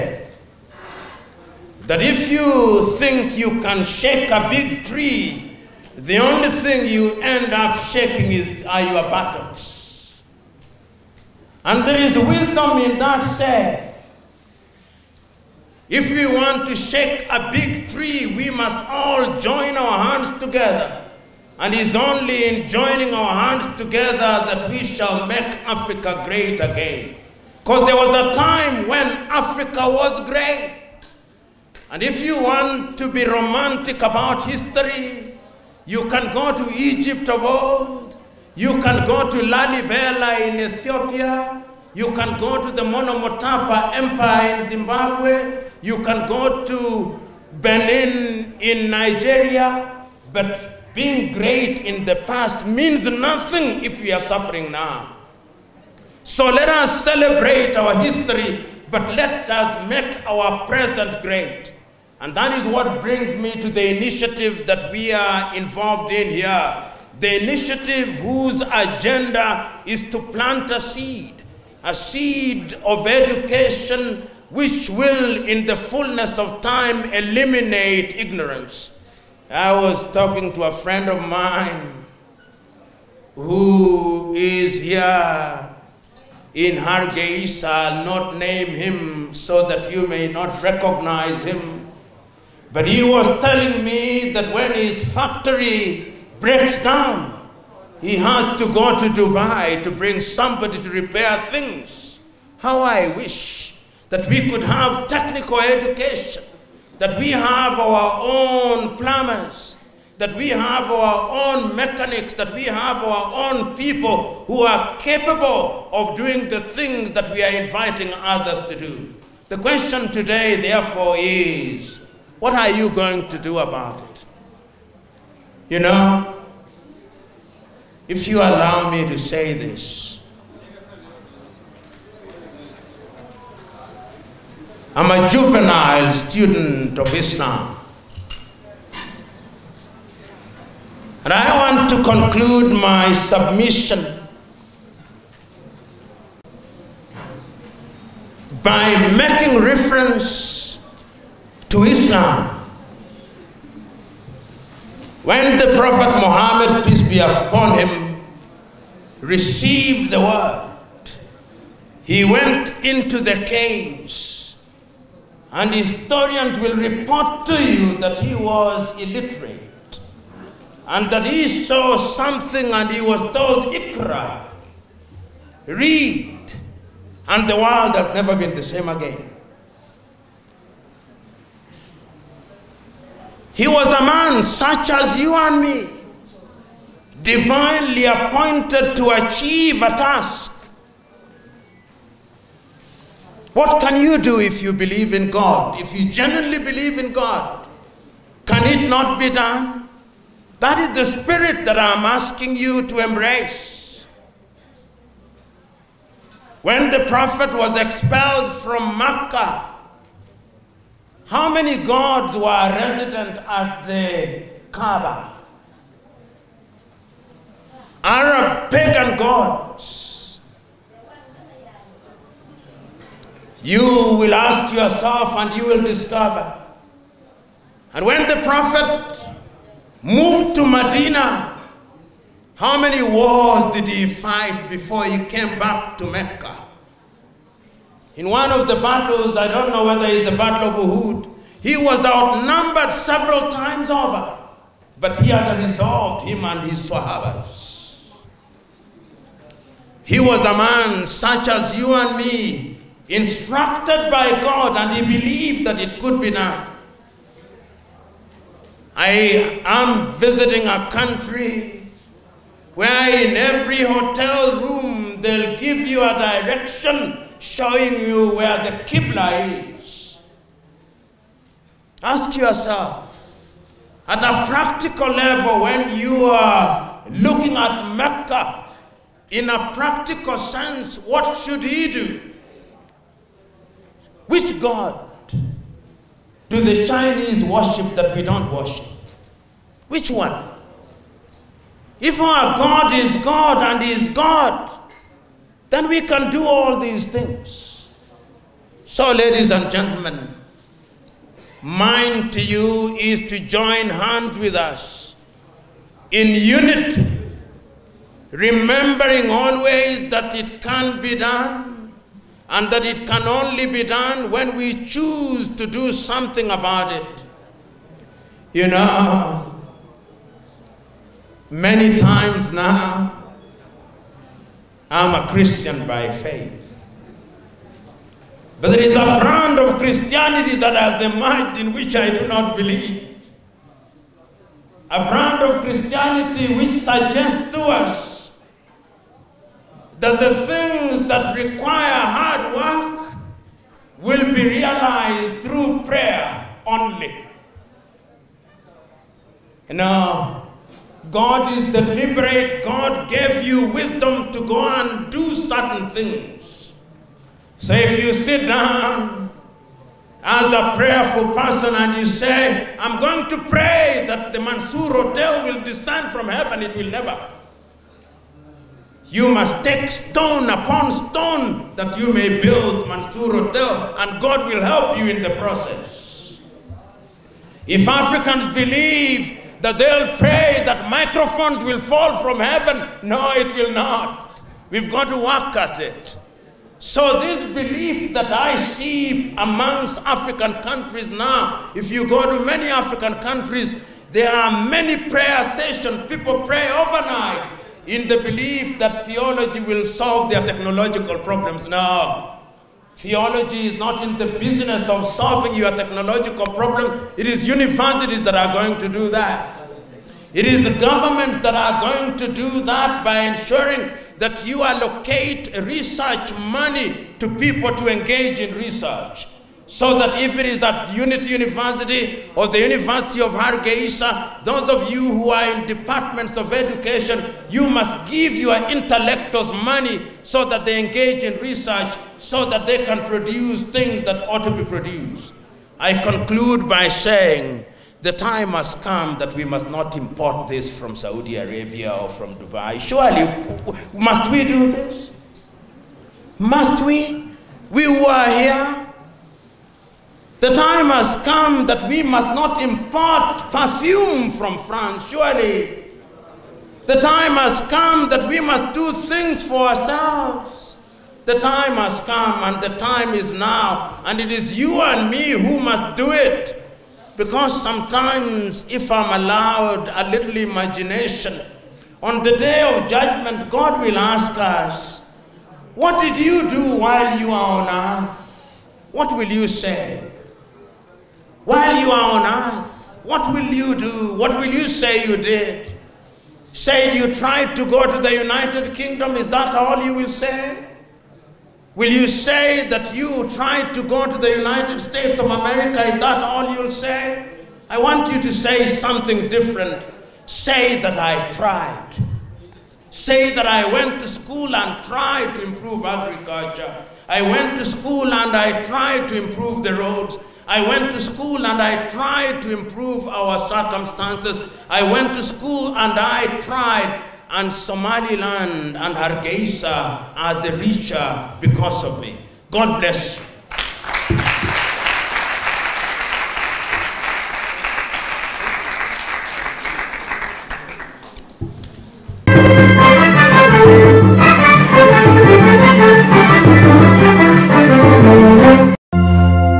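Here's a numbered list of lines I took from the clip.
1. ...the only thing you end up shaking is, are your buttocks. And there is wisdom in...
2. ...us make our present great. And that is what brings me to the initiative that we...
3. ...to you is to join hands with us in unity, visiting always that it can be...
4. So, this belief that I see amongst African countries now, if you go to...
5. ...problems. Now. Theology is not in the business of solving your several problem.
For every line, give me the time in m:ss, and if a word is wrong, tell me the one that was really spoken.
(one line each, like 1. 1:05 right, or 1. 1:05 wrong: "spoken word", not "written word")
1. 0:05 right
2. 0:59 right
3. 5:02 wrong: "remembering", not "visiting"
4. 6:26 right
5. 6:41 wrong: "technological", not "several".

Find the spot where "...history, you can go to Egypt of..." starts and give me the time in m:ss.
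0:34.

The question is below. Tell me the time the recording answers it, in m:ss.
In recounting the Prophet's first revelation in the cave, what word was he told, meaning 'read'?
2:53.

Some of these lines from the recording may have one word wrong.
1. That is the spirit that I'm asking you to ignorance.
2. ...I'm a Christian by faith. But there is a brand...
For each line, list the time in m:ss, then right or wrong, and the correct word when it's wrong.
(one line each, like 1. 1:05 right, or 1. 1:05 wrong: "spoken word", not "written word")
1. 3:20 wrong: "embrace", not "ignorance"
2. 5:24 right.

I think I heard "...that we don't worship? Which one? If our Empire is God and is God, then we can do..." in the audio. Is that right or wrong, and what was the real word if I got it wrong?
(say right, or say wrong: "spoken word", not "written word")
wrong: "God", not "Empire".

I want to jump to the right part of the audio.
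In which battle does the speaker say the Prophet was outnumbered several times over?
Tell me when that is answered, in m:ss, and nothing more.
4:00.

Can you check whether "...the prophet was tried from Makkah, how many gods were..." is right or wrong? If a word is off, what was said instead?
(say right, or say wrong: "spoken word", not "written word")
wrong: "expelled", not "tried".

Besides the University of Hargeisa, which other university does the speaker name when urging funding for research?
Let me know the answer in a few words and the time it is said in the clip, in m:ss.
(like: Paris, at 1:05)
Unity University, at 7:00.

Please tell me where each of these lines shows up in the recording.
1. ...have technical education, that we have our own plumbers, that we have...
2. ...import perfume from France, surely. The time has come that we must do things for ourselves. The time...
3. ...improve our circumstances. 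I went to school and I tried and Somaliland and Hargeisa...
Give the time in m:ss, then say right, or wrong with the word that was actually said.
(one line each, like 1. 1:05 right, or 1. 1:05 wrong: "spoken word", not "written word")
1. 1:44 right
2. 7:32 right
3. 8:32 right.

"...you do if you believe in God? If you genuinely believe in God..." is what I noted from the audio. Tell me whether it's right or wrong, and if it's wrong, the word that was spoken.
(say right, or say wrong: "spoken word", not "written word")
right.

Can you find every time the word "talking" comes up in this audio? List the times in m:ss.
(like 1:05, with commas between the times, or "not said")
1:20.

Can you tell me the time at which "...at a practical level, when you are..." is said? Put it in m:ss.
4:34.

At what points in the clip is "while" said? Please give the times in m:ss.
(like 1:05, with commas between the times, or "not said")
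7:56, 8:01.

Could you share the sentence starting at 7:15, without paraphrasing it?
I conclude by saying the time has come that we must not import this from Saudi Arabia or from Dubai.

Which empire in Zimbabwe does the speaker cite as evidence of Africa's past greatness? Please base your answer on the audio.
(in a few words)
Monomotapa Empire.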